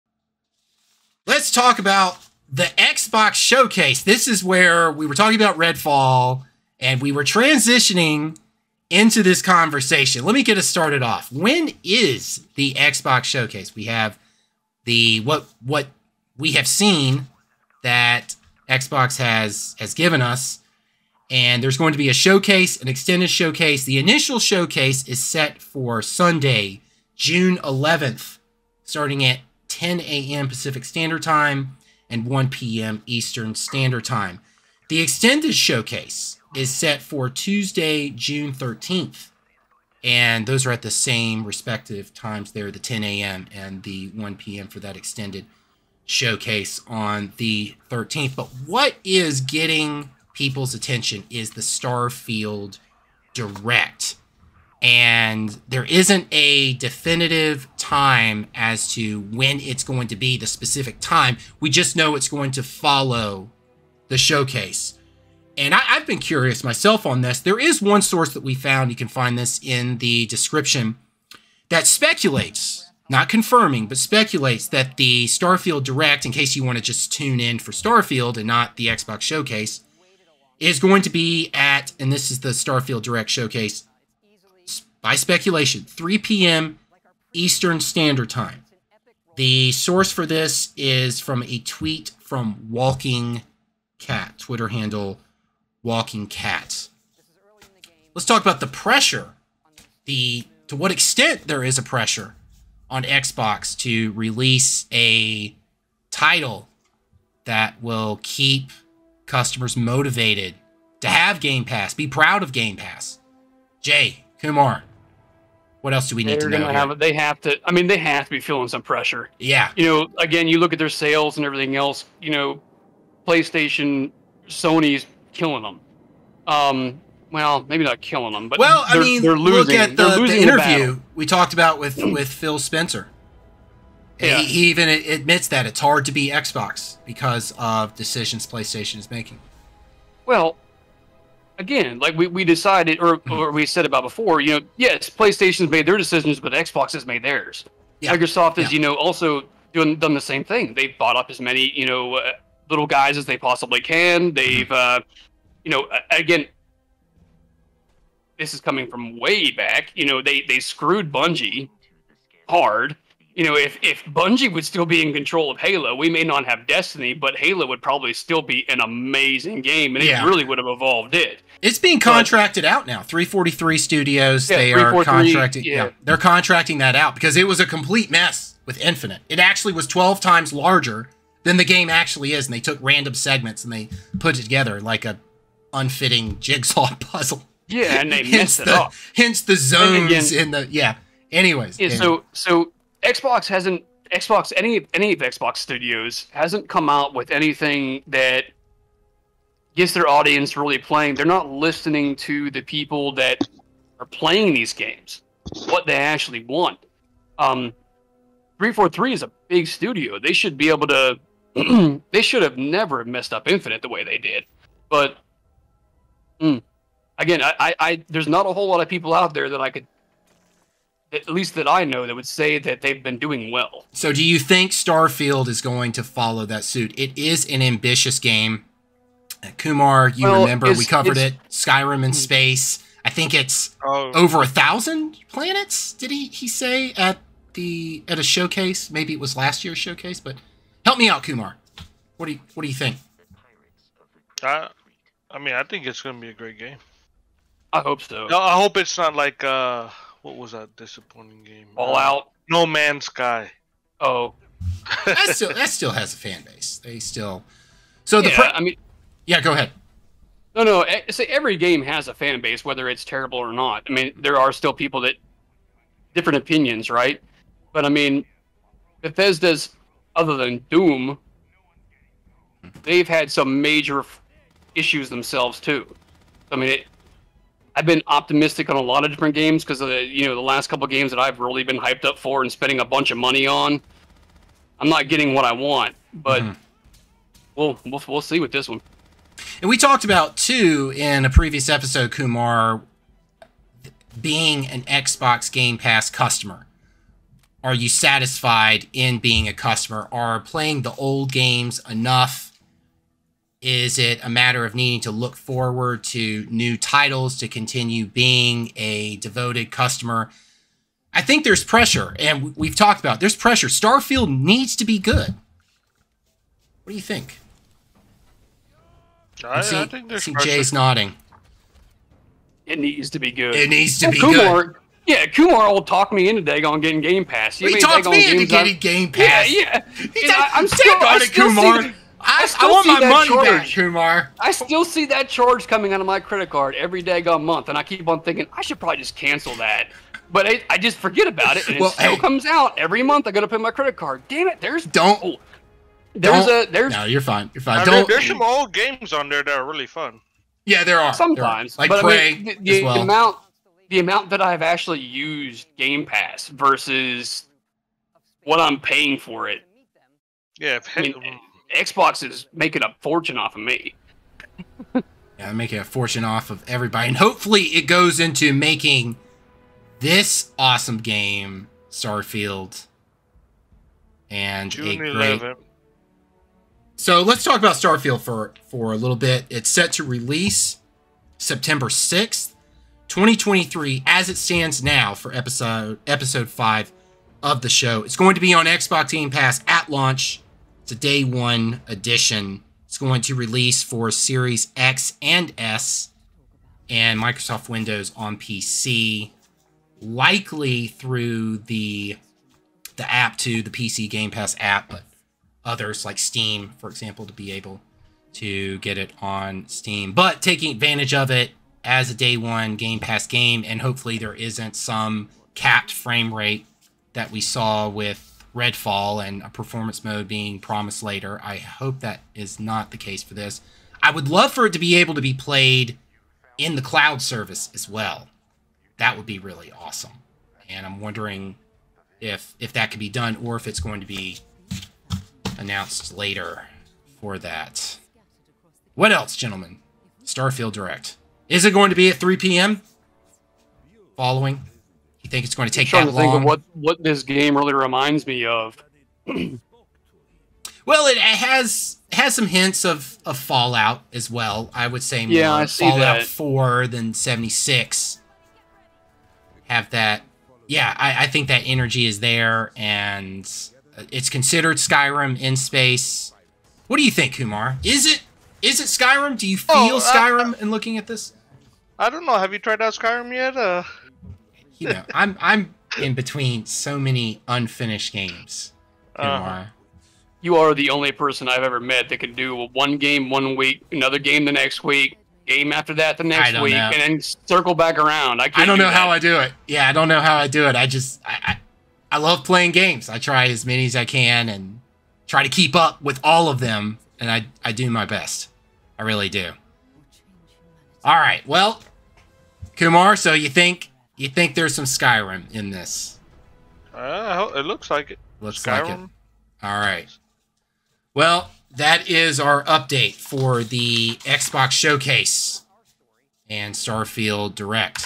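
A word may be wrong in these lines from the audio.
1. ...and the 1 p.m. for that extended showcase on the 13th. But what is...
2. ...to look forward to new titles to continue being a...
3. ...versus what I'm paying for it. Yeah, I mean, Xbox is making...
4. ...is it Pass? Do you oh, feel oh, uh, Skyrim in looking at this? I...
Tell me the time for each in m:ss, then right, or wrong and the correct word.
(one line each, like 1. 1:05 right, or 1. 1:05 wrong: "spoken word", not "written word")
1. 0:43 right
2. 5:05 right
3. 5:56 right
4. 7:48 wrong: "Skyrim", not "Pass".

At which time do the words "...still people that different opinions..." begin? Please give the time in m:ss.
4:24.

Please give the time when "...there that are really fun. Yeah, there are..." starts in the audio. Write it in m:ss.
5:49.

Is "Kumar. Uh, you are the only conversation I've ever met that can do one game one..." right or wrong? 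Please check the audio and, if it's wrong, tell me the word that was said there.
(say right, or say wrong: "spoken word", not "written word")
wrong: "person", not "conversation".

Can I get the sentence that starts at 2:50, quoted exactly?
it really would have evolved it.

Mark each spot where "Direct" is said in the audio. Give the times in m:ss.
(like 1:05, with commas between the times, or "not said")
0:53, 1:15, 1:23, 7:20, 8:37.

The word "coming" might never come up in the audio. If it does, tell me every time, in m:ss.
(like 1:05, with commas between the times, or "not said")
2:38, 5:35.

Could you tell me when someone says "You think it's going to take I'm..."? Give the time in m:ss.
7:25.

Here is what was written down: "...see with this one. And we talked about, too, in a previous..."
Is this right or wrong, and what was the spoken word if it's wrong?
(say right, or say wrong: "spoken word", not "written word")
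right.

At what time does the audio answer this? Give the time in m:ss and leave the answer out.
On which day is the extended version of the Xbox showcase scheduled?
0:37.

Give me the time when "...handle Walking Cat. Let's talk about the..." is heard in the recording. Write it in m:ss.
1:34.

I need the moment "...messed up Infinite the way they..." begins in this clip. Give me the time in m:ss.
3:33.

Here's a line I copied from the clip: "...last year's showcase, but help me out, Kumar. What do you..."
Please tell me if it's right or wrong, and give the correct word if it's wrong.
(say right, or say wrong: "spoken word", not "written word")
right.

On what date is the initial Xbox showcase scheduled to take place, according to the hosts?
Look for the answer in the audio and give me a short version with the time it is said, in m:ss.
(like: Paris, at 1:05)
Sunday, June 11th, at 0:26.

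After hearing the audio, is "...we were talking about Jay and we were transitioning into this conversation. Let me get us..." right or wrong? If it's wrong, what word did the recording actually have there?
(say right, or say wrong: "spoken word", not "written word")
wrong: "Redfall", not "Jay".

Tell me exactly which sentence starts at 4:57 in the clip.
Are you satisfied in being a customer?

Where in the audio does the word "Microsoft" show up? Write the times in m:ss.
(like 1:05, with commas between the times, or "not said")
2:28, 6:37.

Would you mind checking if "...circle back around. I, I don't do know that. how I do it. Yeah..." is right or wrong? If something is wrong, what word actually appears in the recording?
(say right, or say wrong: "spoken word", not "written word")
right.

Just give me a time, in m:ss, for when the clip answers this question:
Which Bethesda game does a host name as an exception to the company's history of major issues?
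4:30.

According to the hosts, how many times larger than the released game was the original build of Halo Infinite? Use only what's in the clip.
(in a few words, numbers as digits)
12 times.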